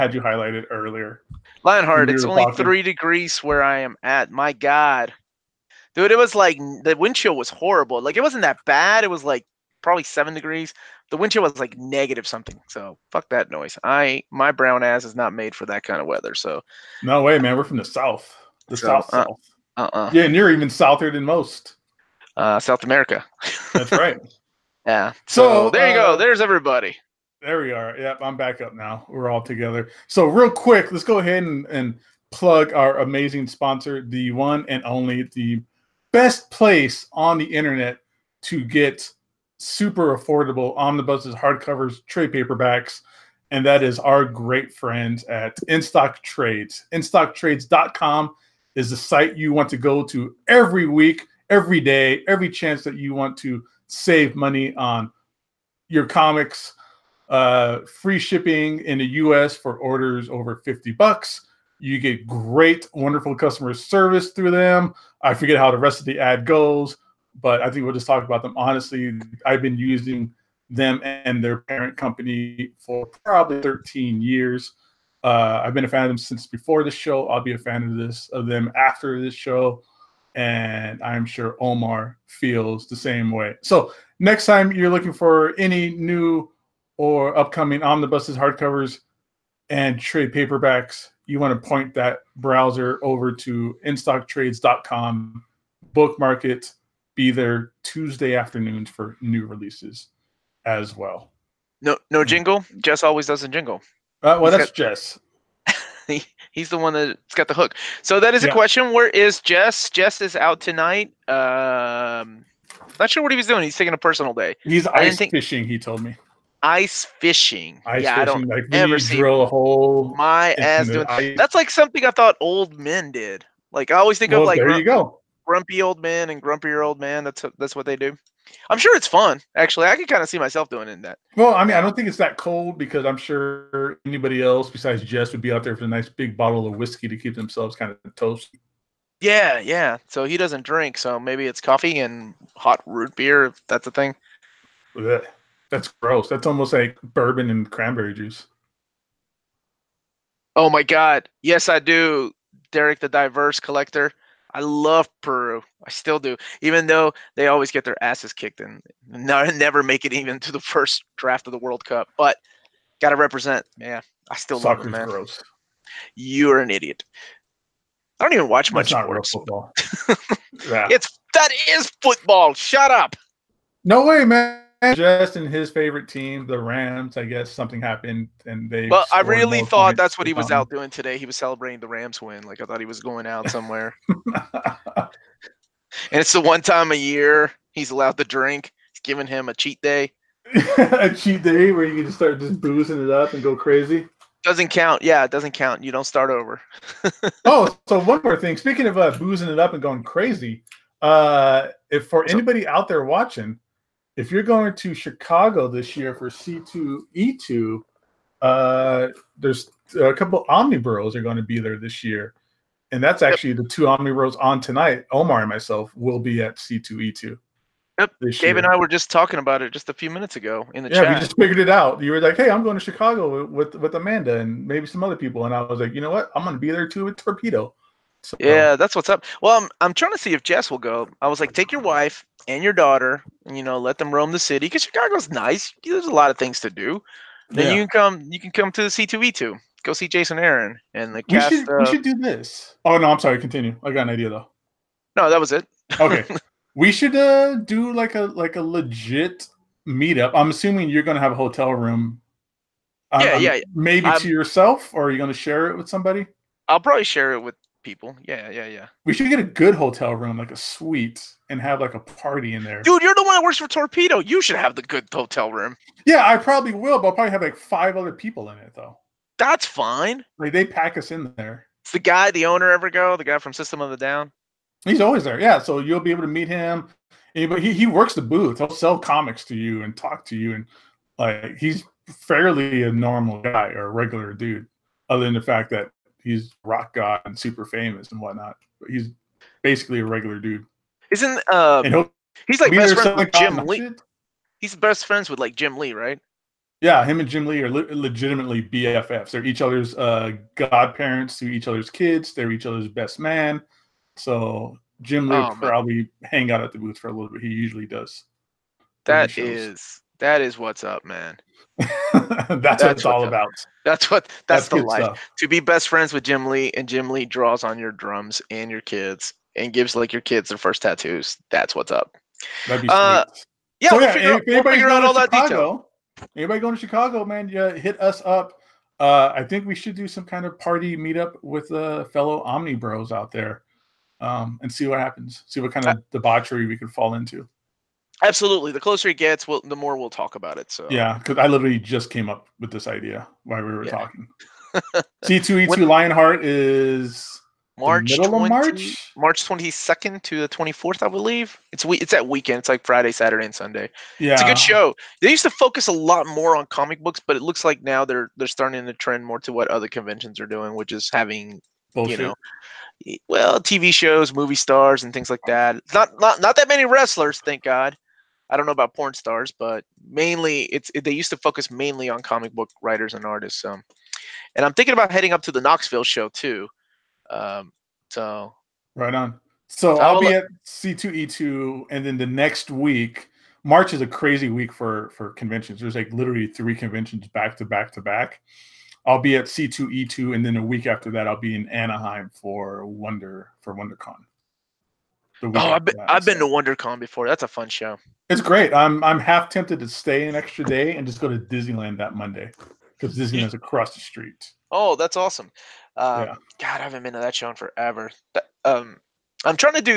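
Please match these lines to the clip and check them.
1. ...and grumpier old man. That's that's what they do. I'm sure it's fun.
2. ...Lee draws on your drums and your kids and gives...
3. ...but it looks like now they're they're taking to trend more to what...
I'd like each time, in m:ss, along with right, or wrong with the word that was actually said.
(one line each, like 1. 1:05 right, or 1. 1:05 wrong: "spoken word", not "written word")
1. 2:06 right
2. 5:17 right
3. 5:57 wrong: "starting", not "taking".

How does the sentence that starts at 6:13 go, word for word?
Um, and I'm thinking about heading up to the Knoxville show too.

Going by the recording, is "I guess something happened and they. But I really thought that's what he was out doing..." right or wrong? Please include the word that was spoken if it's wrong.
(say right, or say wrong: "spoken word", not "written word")
right.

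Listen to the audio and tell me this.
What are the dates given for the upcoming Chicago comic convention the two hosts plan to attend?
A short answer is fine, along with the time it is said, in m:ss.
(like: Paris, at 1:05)
March 22 to 24, at 5:49.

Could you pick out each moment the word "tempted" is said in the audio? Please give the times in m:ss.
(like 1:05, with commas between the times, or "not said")
6:39.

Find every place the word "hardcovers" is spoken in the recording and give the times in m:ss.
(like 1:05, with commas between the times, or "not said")
0:41, 1:28.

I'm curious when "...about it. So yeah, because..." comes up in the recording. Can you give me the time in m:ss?
5:40.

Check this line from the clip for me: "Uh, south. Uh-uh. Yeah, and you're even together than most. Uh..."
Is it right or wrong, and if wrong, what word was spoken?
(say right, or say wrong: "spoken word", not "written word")
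wrong: "souther", not "together".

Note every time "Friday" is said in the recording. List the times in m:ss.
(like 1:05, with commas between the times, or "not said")
5:52.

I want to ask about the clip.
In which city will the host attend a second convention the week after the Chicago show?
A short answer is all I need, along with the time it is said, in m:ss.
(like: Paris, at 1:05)
Anaheim, at 6:31.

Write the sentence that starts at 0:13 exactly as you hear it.
I my brown ass is not made for that kind of weather.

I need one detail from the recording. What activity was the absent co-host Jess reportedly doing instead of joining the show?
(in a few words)
Ice fishing.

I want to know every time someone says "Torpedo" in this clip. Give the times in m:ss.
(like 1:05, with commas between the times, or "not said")
3:47, 4:23.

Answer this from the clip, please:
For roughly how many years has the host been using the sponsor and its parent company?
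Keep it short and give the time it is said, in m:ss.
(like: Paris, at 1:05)
13, at 1:13.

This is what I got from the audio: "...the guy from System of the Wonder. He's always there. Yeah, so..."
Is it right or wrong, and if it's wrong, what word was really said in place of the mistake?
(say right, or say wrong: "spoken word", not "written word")
wrong: "Down", not "Wonder".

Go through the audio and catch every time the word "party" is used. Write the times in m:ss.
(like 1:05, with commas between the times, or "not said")
4:21, 5:30.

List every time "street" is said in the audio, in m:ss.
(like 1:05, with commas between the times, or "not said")
6:44.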